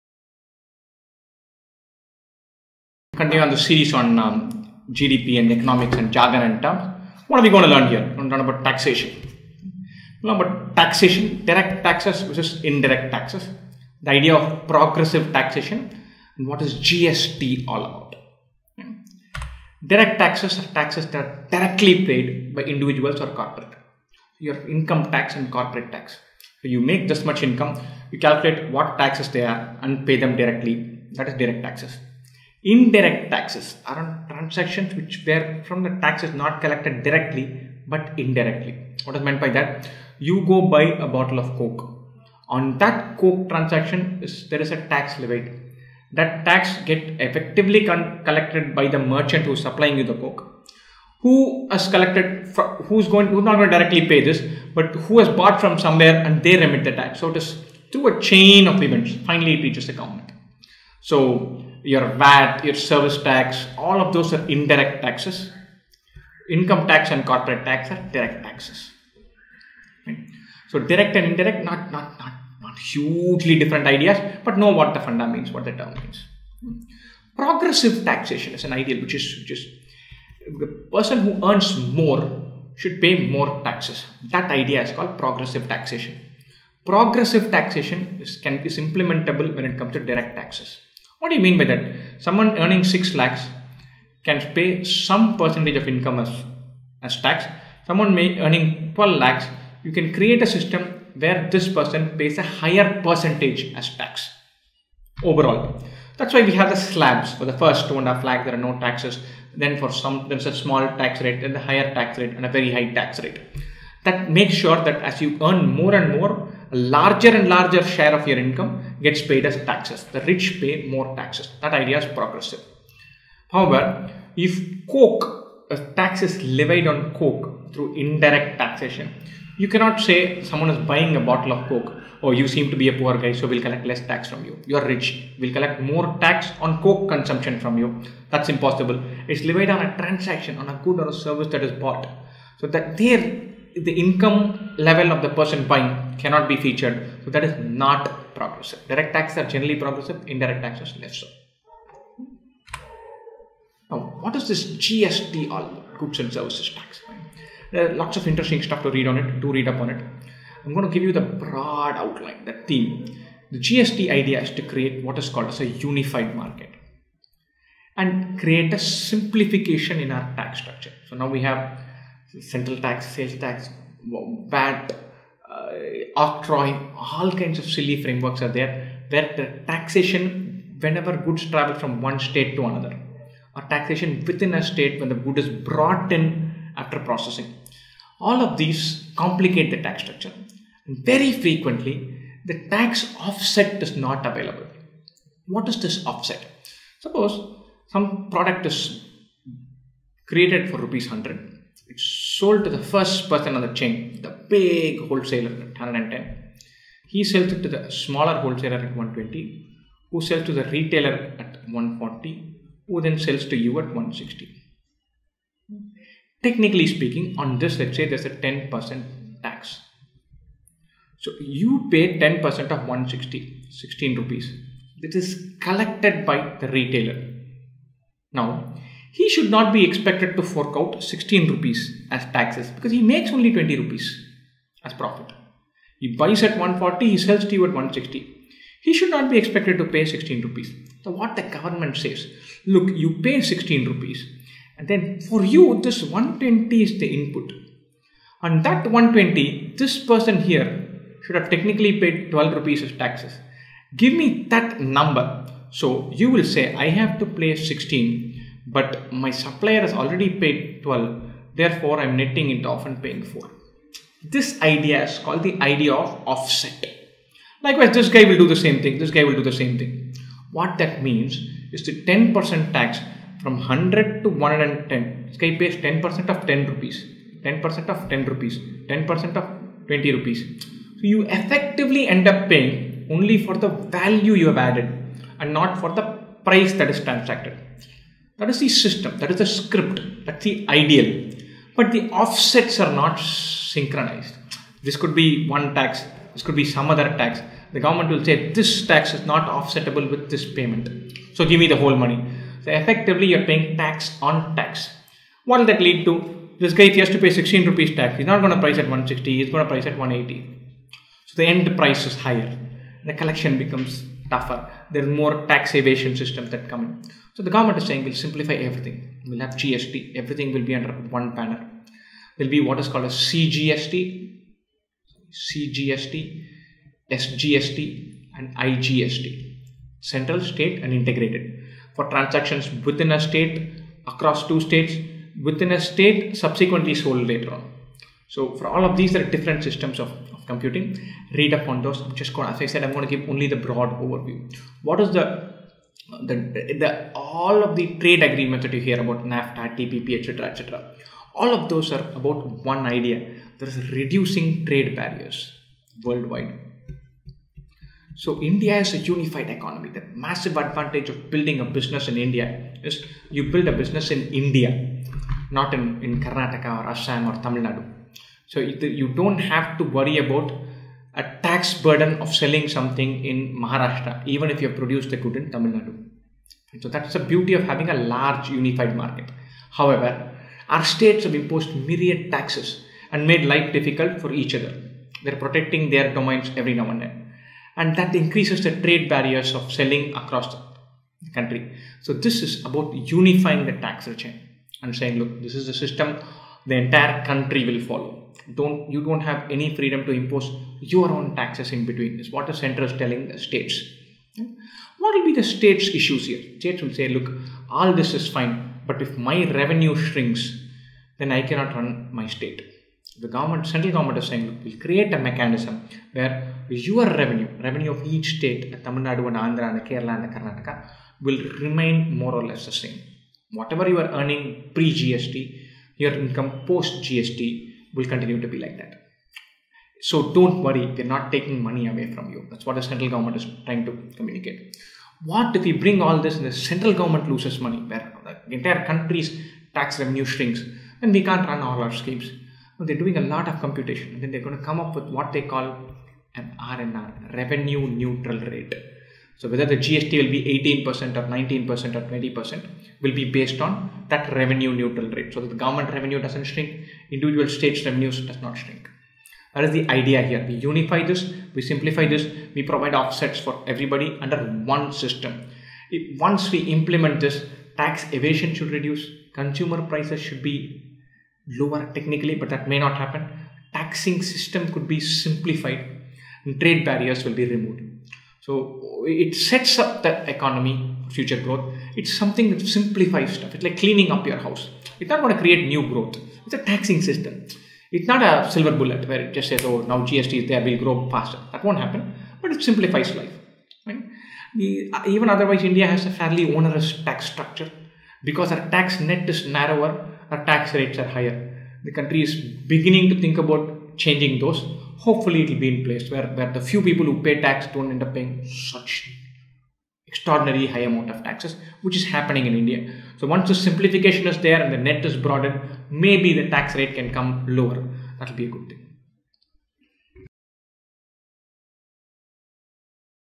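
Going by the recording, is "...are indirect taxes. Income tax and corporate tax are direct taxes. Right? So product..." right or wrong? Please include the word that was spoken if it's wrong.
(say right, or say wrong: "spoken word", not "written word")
wrong: "direct", not "product".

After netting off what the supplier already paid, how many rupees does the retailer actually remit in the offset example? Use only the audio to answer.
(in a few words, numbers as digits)
4.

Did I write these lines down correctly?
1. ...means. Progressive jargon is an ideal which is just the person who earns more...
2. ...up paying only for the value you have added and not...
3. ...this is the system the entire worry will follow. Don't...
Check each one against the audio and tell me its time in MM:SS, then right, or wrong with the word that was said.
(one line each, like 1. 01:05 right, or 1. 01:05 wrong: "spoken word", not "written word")
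1. 01:15 wrong: "taxation", not "jargon"
2. 04:42 right
3. 06:35 wrong: "country", not "worry".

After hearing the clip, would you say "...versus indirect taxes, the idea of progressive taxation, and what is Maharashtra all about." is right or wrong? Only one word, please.
wrong.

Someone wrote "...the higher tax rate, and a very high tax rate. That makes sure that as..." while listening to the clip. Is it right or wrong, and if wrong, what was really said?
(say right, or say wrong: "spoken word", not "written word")
right.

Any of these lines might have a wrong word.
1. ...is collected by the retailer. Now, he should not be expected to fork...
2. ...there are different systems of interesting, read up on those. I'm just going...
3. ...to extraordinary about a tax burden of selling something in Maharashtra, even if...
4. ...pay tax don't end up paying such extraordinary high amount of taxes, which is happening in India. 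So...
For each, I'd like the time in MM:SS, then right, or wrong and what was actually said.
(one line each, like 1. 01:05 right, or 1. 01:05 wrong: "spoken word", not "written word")
1. 03:45 right
2. 05:39 wrong: "computing", not "interesting"
3. 06:09 wrong: "worry", not "extraordinary"
4. 08:27 right.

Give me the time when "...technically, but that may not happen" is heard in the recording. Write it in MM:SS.
07:51.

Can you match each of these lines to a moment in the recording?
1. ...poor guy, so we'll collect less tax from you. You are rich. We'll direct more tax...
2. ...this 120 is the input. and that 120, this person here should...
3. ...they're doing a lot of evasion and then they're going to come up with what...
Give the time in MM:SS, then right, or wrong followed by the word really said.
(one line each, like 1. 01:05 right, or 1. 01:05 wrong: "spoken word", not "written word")
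1. 02:12 wrong: "collect", not "direct"
2. 04:05 right
3. 07:22 wrong: "computation", not "evasion".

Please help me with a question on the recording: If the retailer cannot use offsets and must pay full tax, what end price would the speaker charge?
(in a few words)
180.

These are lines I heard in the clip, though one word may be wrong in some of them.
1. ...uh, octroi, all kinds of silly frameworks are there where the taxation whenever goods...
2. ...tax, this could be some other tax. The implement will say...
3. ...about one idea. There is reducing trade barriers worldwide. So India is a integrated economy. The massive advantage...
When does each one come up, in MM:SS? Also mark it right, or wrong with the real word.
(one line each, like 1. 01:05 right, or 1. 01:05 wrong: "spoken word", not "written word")
1. 02:55 right
2. 04:55 wrong: "government", not "implement"
3. 05:52 wrong: "unified", not "integrated".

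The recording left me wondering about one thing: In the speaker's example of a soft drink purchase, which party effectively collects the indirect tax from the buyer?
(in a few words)
the merchant.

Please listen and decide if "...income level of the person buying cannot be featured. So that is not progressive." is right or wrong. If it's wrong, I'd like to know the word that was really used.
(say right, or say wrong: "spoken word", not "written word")
right.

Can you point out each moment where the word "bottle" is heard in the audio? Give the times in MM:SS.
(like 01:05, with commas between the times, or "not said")
00:41, 02:11.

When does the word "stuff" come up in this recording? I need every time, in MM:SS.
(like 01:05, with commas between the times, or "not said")
02:38, 08:03.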